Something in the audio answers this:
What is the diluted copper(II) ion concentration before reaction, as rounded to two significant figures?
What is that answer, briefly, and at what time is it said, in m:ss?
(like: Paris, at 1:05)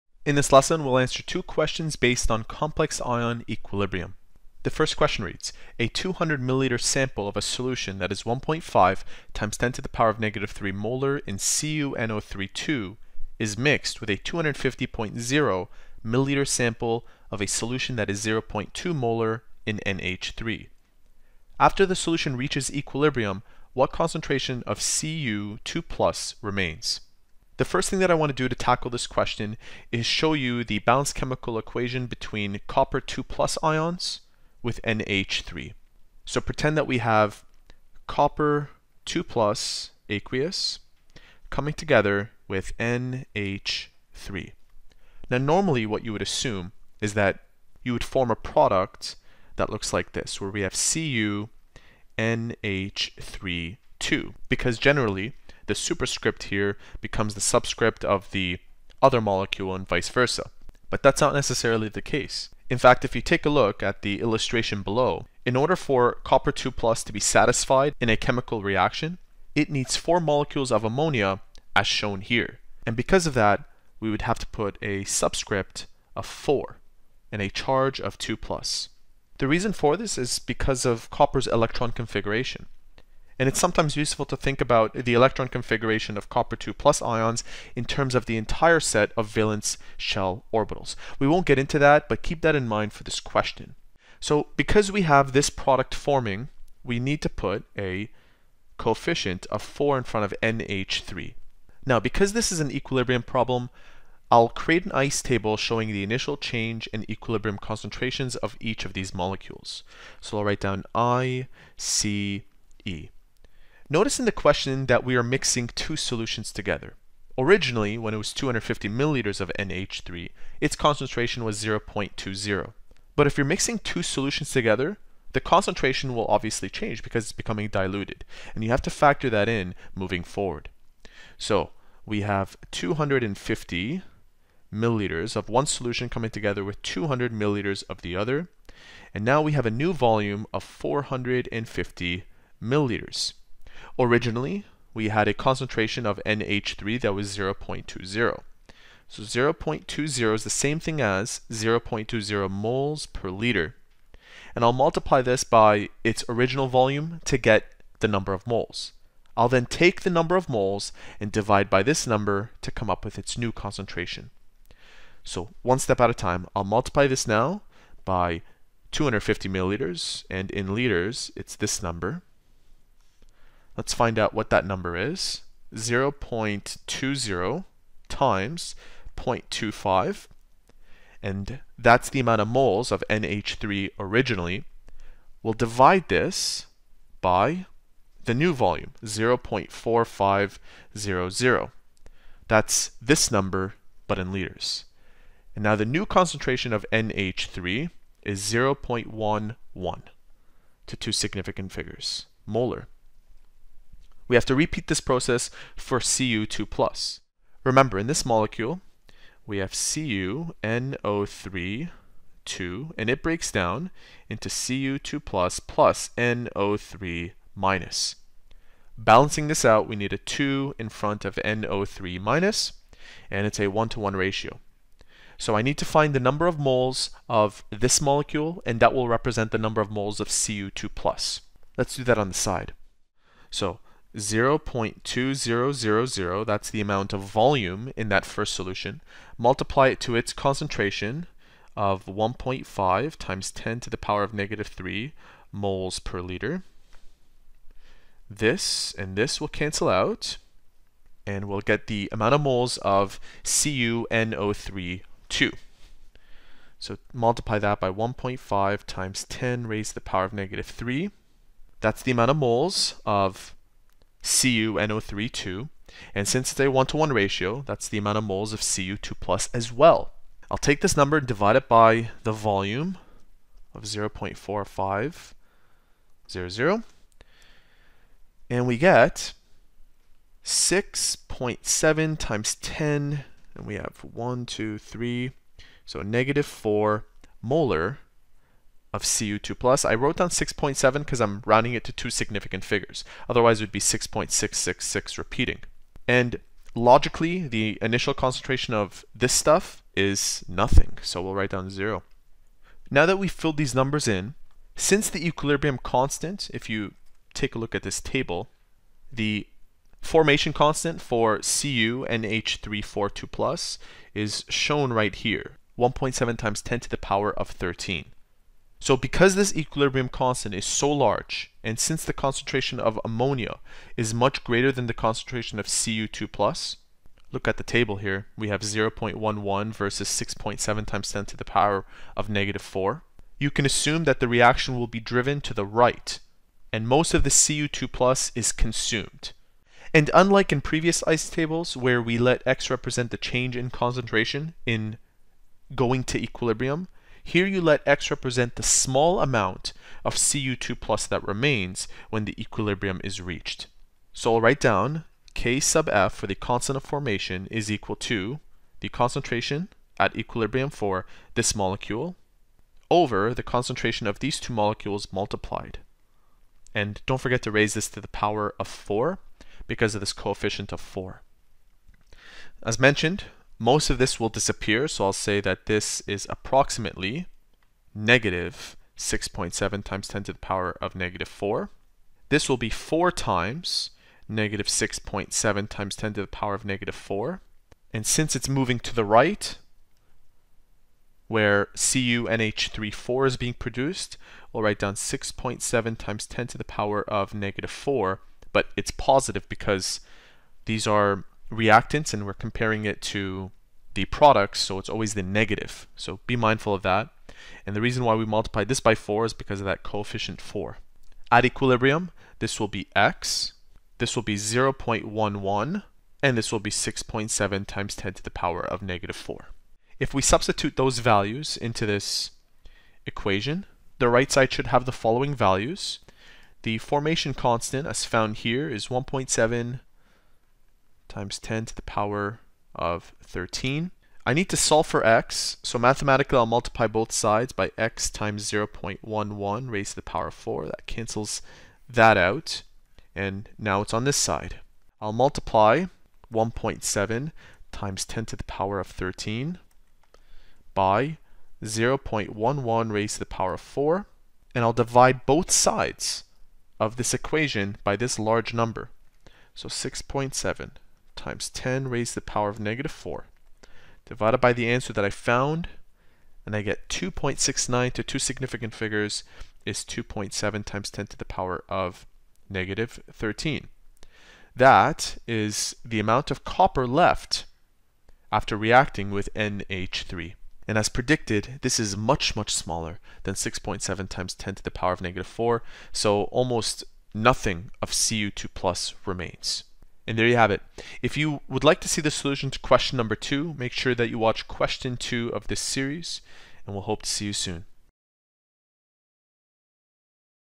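6.7 x 10^-4 molar, at 4:40.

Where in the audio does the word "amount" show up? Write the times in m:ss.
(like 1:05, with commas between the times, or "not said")
3:02, 3:56, 4:12, 4:22, 4:27, 5:49, 7:55.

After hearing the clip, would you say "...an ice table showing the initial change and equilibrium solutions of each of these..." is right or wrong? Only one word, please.
wrong.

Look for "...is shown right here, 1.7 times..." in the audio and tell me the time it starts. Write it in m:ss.
5:14.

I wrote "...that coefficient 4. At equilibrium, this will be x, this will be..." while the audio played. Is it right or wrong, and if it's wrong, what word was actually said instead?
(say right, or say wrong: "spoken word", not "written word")
right.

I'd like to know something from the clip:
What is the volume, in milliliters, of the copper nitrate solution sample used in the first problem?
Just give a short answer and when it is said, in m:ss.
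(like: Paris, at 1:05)
200 milliliters, at 0:05.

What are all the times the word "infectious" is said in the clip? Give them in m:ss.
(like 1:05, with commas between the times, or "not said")
not said.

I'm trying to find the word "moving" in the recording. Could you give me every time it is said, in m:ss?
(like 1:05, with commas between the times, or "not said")
2:09, 6:28.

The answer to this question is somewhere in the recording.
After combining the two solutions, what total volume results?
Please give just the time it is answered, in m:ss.
2:20.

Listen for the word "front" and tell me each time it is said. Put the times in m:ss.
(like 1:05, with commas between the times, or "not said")
1:40, 3:40.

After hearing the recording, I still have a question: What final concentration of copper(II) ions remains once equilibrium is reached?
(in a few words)
2.7 x 10^-13 molar.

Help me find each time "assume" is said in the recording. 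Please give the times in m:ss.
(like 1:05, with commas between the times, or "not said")
0:46, 5:33.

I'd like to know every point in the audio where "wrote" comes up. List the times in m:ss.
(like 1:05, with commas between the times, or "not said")
4:49.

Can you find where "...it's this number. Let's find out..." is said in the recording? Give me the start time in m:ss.
2:51.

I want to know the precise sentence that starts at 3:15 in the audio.
And now the new concentration of NH3 is 0.11 to two significant figures, molar.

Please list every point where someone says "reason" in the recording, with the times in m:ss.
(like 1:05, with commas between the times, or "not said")
1:19, 6:47.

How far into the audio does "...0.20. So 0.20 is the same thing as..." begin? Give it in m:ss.
2:27.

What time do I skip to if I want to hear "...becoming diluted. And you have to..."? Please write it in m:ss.
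2:07.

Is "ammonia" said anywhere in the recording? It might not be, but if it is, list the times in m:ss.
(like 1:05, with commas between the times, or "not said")
1:10, 5:23.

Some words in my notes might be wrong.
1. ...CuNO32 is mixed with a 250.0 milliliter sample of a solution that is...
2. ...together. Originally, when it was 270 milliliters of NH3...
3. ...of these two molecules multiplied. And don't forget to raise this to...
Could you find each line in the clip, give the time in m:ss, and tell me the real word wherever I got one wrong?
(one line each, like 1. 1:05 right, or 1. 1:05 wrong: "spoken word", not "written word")
1. 0:11 right
2. 1:56 wrong: "250", not "270"
3. 6:04 right.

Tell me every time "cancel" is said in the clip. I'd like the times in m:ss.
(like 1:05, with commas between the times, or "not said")
4:09, 7:20.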